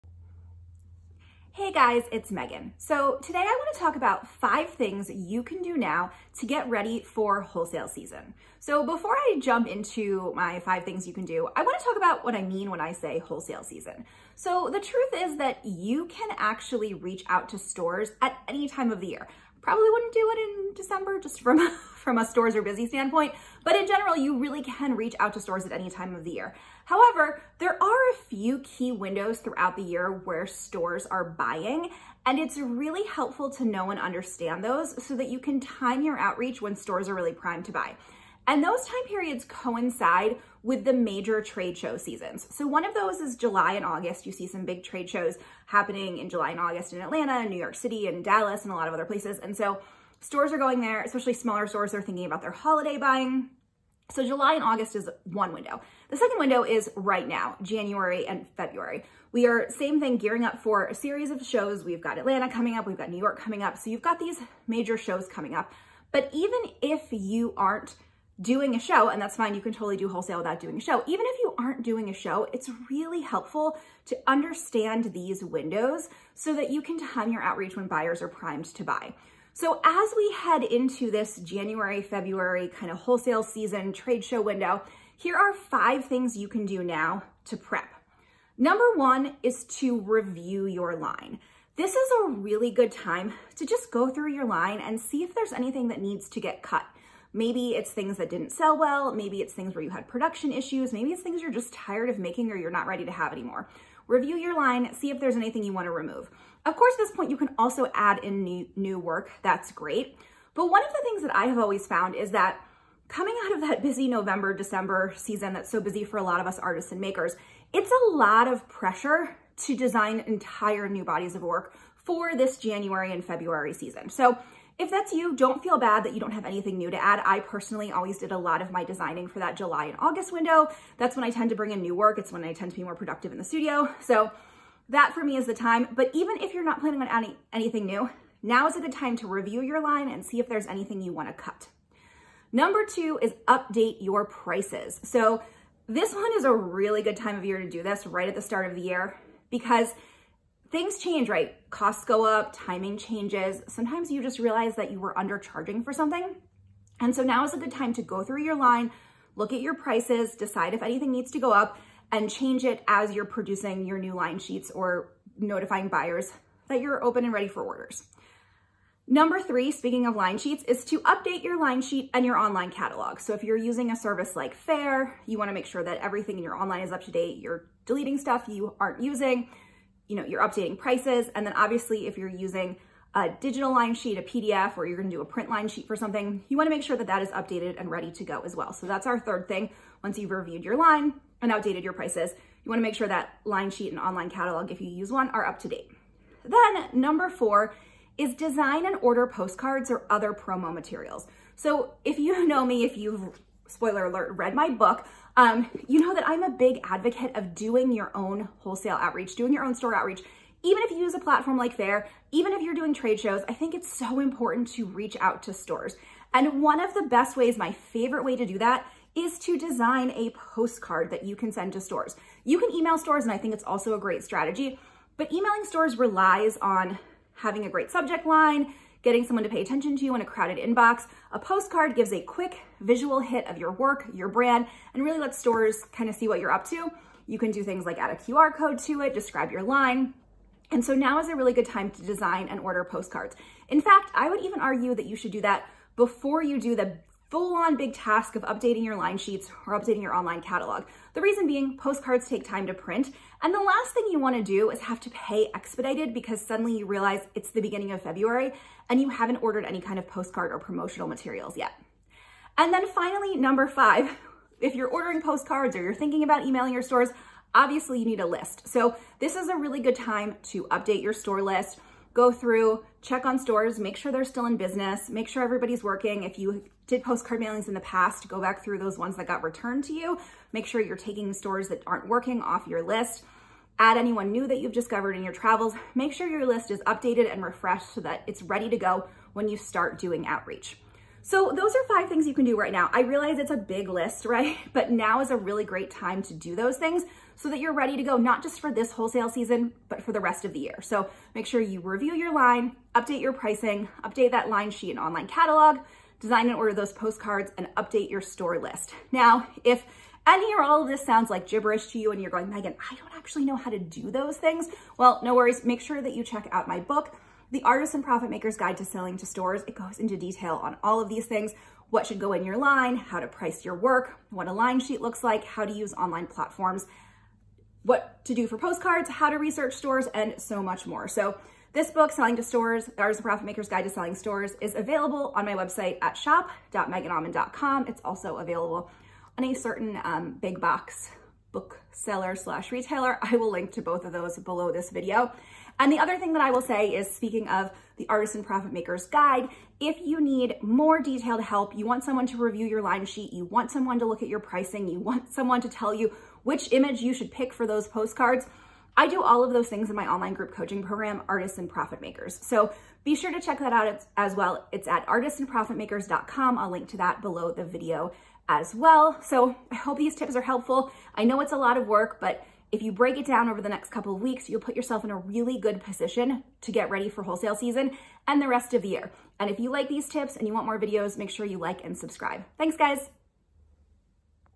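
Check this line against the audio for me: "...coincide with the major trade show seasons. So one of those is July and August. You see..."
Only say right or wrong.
right.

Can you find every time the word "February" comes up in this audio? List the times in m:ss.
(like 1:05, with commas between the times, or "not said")
0:58, 1:22, 2:03, 4:18.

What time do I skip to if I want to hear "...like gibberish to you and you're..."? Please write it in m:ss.
5:11.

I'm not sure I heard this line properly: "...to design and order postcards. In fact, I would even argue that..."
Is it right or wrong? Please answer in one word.
right.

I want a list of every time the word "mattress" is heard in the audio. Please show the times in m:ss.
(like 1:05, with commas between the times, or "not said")
not said.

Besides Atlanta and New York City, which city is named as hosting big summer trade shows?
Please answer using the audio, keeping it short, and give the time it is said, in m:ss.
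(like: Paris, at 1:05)
Dallas, at 0:48.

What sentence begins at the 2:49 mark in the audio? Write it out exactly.
Number three, speaking of line sheets, is to update your line sheet and your online catalog.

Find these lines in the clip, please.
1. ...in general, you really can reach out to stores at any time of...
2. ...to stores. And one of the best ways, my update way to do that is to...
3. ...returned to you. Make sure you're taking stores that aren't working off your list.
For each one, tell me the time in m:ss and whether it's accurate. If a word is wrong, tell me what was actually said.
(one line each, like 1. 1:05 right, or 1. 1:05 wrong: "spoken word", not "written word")
1. 0:23 right
2. 3:35 wrong: "favorite", not "update"
3. 4:39 right.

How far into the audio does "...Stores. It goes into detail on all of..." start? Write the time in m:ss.
5:19.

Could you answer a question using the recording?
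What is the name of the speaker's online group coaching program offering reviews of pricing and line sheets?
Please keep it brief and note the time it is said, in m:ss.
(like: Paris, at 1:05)
Artists and Profit Makers, at 6:01.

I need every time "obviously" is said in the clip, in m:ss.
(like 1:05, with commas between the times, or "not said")
3:01, 4:27.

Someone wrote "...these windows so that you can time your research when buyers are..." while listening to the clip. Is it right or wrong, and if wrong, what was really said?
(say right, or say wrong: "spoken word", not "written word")
wrong: "outreach", not "research".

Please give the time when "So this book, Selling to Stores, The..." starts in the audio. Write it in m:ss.
5:31.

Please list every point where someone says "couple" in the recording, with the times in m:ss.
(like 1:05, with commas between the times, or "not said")
6:13.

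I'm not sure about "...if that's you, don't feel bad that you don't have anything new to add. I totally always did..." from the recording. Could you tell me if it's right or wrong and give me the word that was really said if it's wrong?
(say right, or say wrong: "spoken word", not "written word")
wrong: "personally", not "totally".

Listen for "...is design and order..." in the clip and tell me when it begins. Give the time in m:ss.
3:18.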